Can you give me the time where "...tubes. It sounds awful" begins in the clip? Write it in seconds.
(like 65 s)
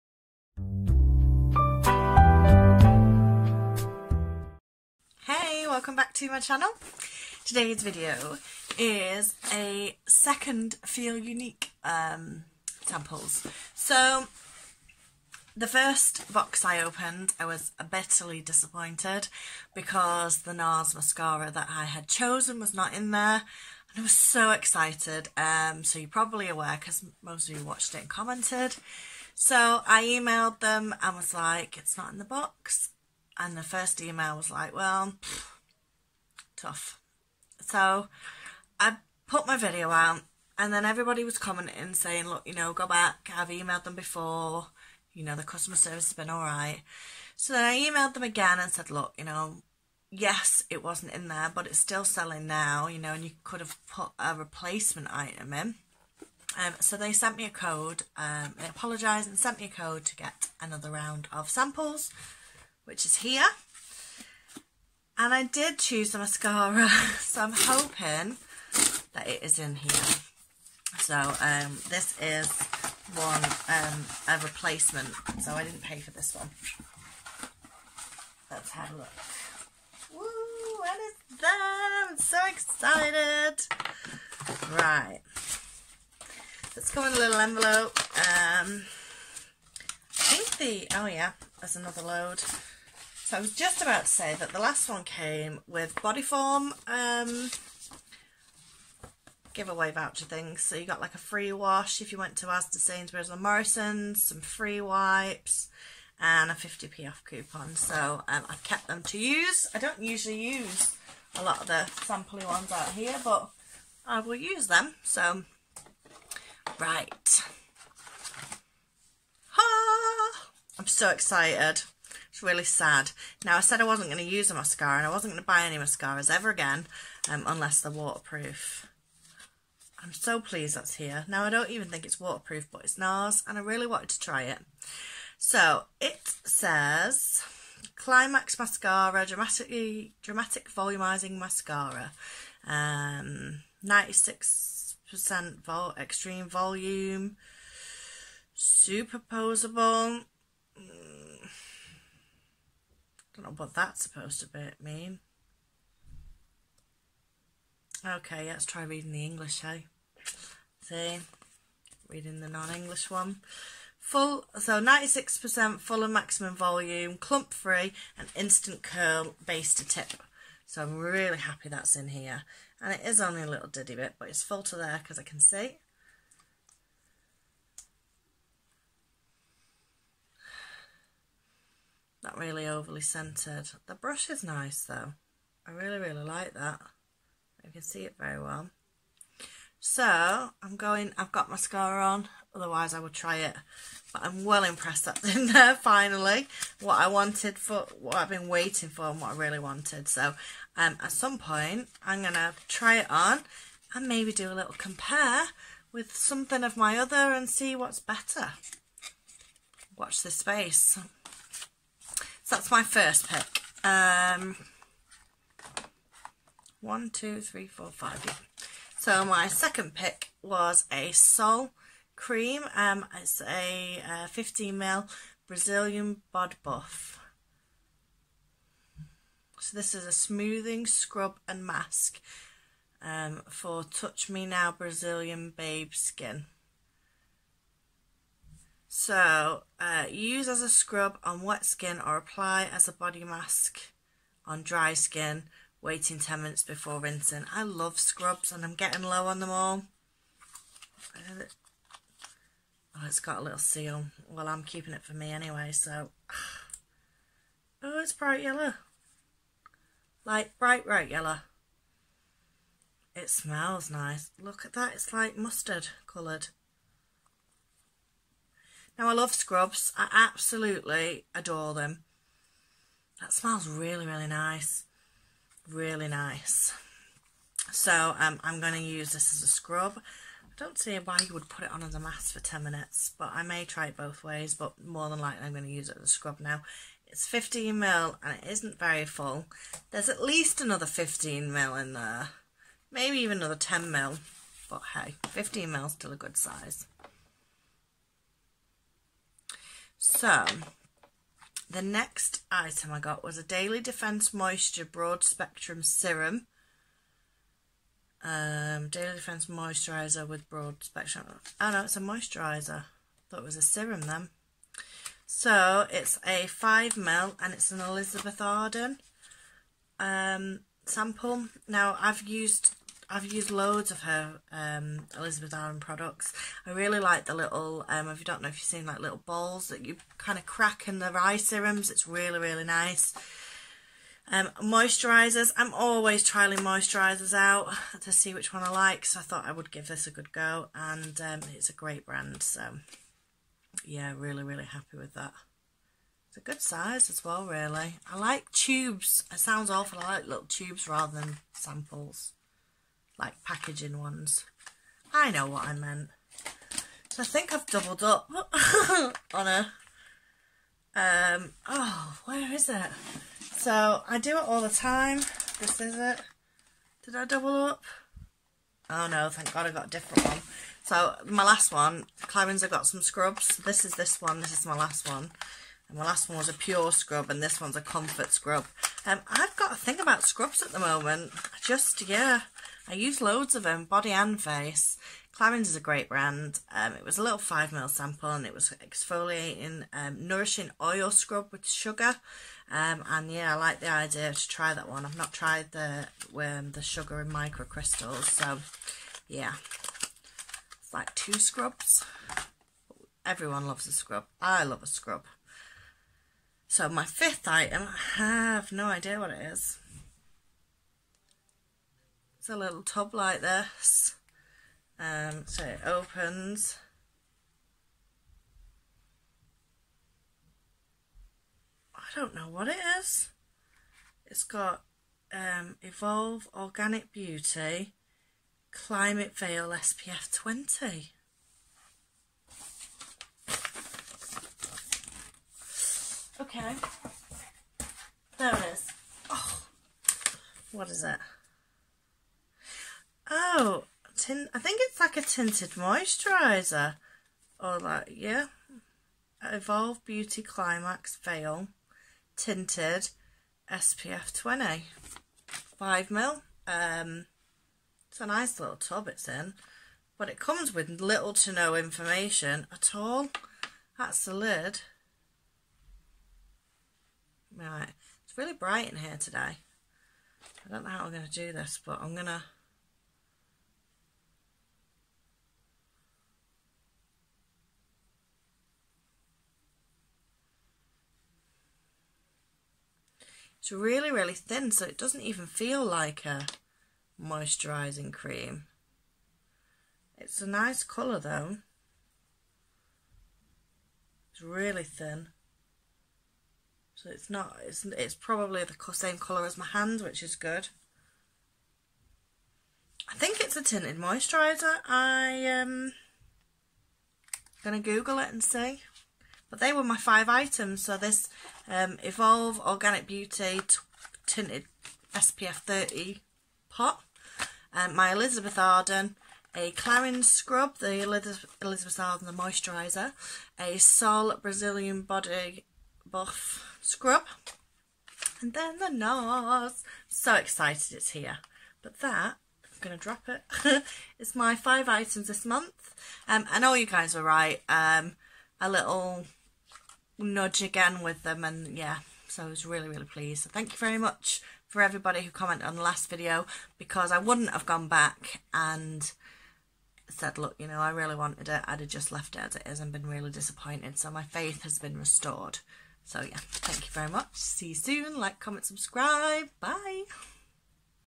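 348 s.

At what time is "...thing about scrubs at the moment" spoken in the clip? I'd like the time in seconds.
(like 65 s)
379 s.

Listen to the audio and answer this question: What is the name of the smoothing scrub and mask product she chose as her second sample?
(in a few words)
Brazilian Bod Buff.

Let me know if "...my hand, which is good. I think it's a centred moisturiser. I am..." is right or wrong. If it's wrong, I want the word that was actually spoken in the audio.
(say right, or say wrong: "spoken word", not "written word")
wrong: "tinted", not "centred".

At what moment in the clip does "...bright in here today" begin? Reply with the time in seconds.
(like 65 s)
468 s.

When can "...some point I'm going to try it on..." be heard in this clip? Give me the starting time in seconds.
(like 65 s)
201 s.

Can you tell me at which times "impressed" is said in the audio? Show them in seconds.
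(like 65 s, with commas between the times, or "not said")
194 s.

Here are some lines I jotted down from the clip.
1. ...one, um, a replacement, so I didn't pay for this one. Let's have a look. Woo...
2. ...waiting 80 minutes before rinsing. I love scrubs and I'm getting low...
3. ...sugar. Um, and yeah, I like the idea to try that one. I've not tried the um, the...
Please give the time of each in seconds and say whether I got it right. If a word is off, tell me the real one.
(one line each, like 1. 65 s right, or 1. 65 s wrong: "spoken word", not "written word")
1. 73 s right
2. 245 s wrong: "10", not "80"
3. 391 s right.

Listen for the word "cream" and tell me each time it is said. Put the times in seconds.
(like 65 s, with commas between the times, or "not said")
222 s, 488 s.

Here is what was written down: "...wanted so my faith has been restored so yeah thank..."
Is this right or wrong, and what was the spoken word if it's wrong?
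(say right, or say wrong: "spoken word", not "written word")
wrong: "disappointed", not "wanted".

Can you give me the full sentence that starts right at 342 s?
So yeah, really, really happy with that.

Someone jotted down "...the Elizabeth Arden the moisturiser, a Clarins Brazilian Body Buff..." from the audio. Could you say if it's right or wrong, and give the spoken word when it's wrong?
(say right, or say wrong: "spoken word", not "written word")
wrong: "Sol", not "Clarins".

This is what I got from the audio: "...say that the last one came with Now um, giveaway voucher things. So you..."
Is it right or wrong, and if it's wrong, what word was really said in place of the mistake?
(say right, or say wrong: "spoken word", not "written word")
wrong: "Bodyform", not "Now".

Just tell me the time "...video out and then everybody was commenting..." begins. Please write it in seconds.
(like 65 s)
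39 s.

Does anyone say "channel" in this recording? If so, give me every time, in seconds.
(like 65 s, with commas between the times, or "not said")
6 s.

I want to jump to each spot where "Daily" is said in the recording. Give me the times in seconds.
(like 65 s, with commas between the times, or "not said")
303 s, 308 s.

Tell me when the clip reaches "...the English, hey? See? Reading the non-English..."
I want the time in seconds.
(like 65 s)
159 s.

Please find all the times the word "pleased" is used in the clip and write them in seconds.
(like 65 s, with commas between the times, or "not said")
130 s, 543 s.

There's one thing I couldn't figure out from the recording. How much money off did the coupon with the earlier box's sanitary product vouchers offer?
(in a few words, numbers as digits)
50p.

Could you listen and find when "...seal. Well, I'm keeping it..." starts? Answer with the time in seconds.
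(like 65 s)
253 s.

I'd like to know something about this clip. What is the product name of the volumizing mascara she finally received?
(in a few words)
Climax Mascara.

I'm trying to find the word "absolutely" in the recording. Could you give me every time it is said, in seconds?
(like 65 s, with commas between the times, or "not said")
270 s.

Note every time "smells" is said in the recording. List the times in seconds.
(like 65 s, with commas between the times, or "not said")
263 s, 273 s.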